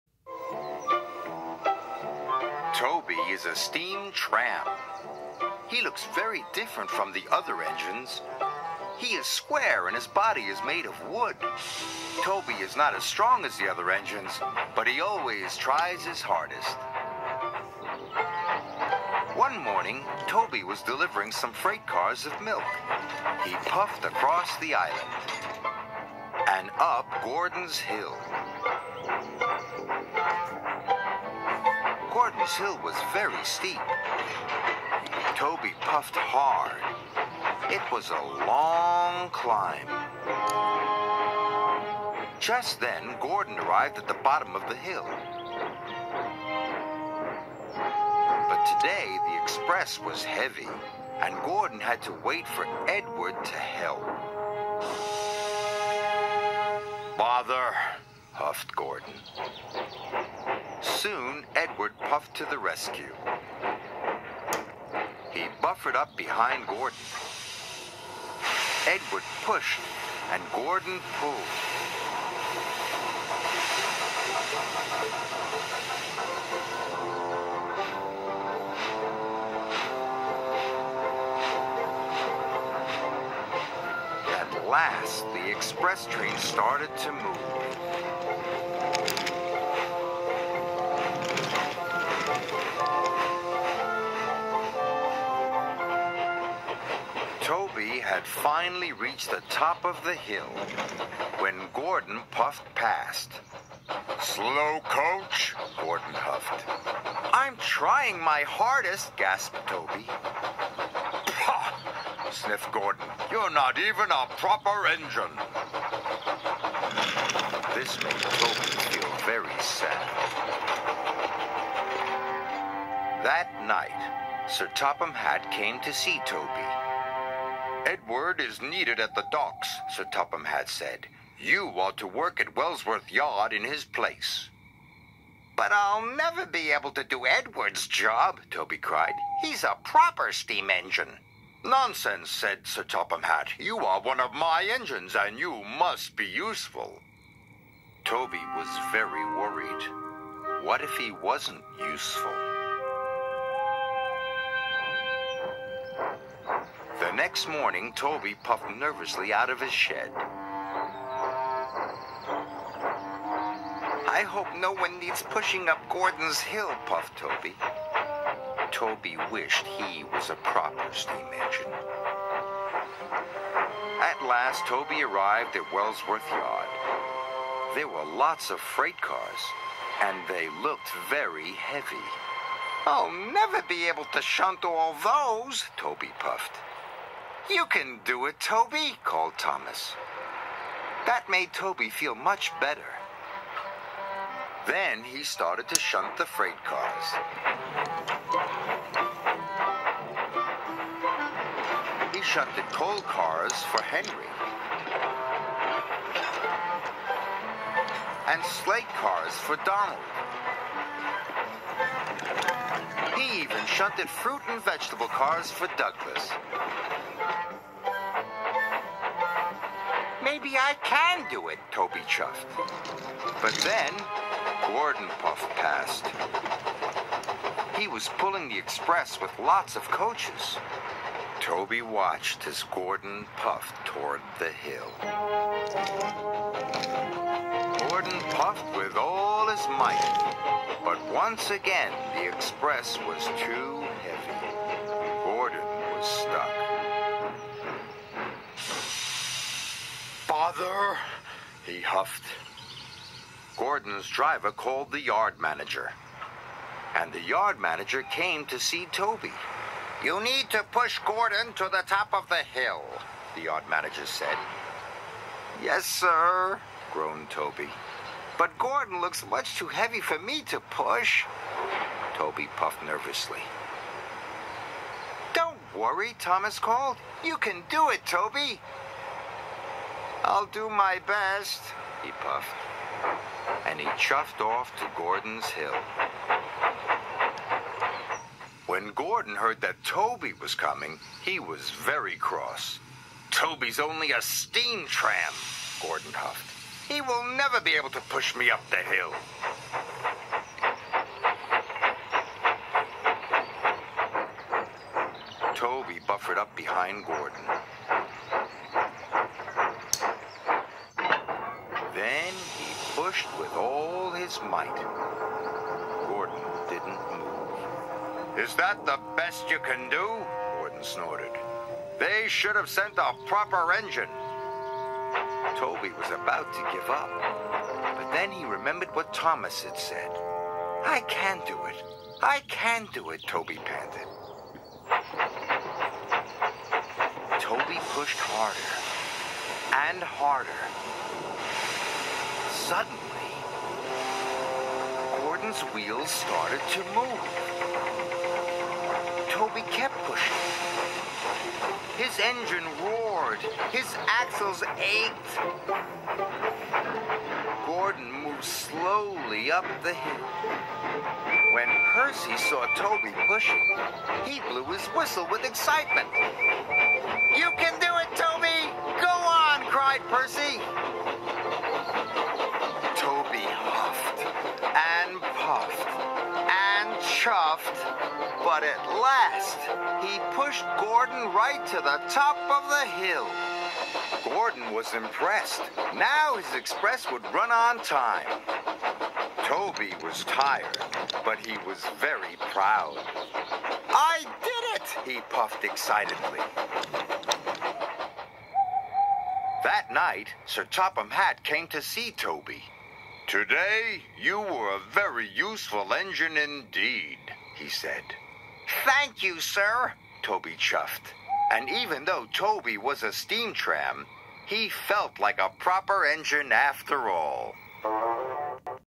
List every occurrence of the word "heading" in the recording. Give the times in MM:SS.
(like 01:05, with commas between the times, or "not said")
not said.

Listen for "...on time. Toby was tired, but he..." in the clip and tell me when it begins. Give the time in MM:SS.
06:27.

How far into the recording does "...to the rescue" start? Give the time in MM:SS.
01:02.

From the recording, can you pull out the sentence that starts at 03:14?
Then he started to shunt the freight cars.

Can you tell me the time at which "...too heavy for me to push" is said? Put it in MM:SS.
04:29.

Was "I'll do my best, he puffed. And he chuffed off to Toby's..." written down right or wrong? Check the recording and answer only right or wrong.
wrong.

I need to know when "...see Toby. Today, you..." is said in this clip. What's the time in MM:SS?
06:41.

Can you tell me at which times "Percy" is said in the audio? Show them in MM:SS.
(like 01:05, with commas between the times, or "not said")
06:01, 06:10.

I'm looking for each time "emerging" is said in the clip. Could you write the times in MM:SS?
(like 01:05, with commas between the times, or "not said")
not said.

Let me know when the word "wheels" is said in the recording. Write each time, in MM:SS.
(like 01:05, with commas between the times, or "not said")
05:45.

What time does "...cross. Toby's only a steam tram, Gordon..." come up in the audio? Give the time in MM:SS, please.
04:52.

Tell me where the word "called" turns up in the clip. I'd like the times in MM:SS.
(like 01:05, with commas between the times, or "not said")
03:09, 04:14, 04:36.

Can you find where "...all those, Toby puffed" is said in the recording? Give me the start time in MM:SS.
03:04.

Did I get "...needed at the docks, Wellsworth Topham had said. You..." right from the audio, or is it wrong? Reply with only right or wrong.
wrong.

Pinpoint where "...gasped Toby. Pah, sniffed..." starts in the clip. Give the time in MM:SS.
01:49.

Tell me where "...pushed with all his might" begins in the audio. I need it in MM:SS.
05:13.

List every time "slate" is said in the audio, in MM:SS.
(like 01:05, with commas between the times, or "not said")
03:28.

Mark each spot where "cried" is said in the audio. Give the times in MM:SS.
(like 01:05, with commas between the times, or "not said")
02:18, 06:09.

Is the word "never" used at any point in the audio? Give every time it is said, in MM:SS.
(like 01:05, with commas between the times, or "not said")
02:16, 03:03, 04:57.